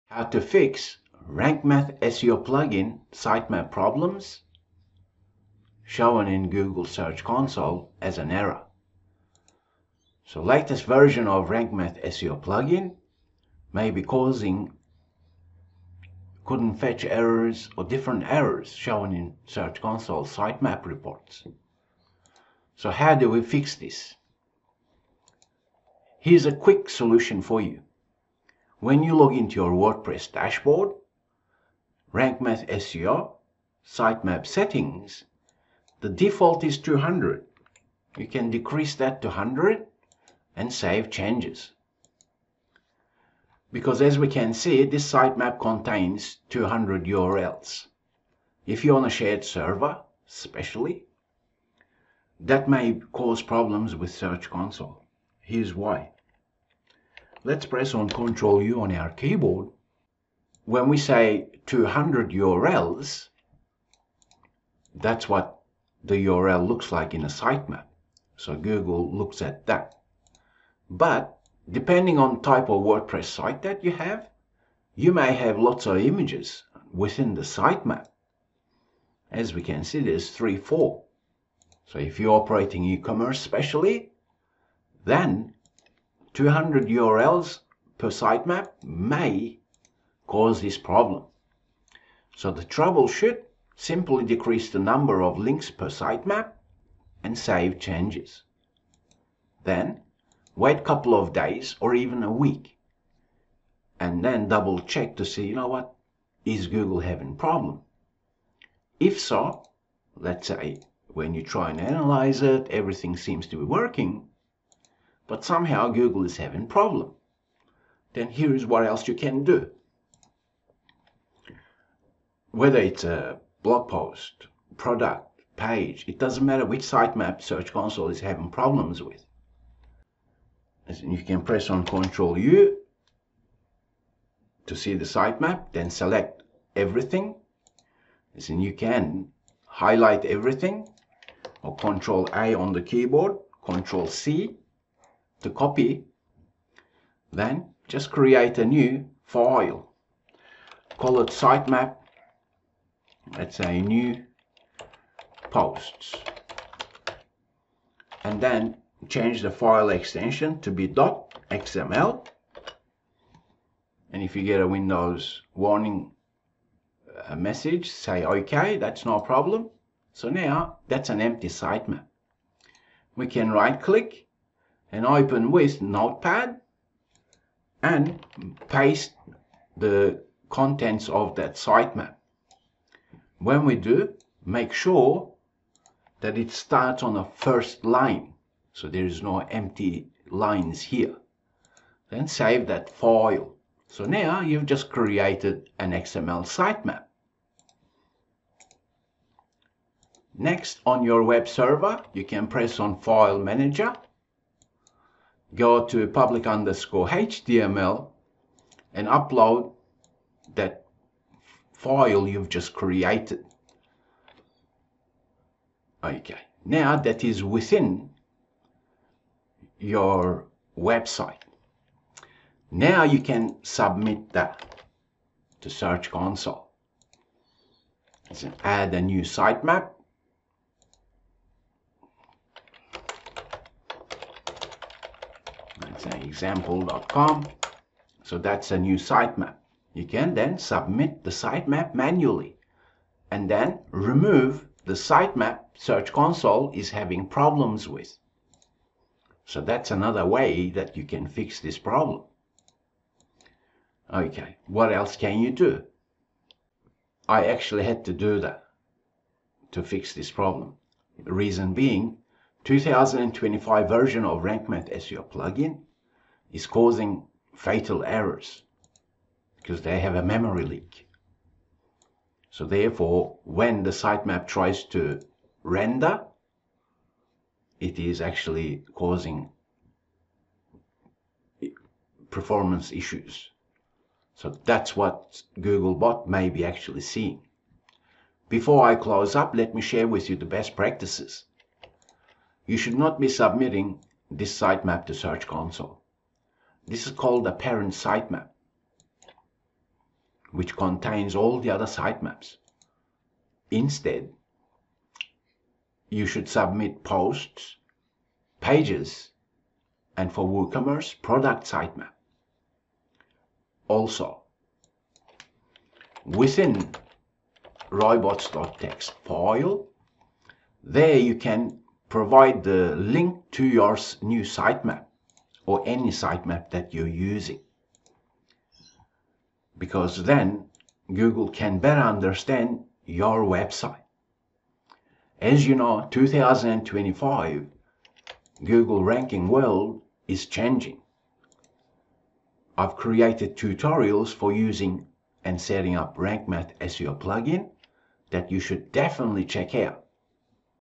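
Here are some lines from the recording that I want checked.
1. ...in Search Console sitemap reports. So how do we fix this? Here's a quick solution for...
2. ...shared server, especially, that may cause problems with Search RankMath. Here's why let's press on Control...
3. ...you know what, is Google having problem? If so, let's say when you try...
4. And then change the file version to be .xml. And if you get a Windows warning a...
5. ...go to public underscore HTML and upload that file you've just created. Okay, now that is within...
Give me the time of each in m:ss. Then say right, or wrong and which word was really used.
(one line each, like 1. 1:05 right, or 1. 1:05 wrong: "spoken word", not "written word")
1. 0:19 right
2. 0:49 wrong: "Console", not "RankMath"
3. 1:45 right
4. 2:38 wrong: "extension", not "version"
5. 3:25 right.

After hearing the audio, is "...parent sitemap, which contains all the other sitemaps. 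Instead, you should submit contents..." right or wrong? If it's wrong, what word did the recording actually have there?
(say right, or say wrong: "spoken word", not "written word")
wrong: "posts", not "contents".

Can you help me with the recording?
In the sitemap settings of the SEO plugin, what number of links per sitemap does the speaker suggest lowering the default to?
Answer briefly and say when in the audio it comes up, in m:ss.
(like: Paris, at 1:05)
100, at 0:39.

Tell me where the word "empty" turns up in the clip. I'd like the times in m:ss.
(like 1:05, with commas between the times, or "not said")
2:51, 3:09.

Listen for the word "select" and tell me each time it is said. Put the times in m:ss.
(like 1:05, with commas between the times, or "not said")
2:15.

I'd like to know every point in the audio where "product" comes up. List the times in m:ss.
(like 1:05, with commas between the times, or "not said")
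2:04, 5:11.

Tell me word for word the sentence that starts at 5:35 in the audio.
As you know, 2025 Google ranking world is changing.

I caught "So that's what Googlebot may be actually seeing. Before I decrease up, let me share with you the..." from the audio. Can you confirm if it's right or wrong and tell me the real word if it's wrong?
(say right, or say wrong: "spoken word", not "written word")
wrong: "close", not "decrease".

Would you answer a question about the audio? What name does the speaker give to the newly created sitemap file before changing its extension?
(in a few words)
new posts.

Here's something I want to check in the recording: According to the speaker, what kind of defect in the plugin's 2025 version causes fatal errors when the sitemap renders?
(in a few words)
memory leak.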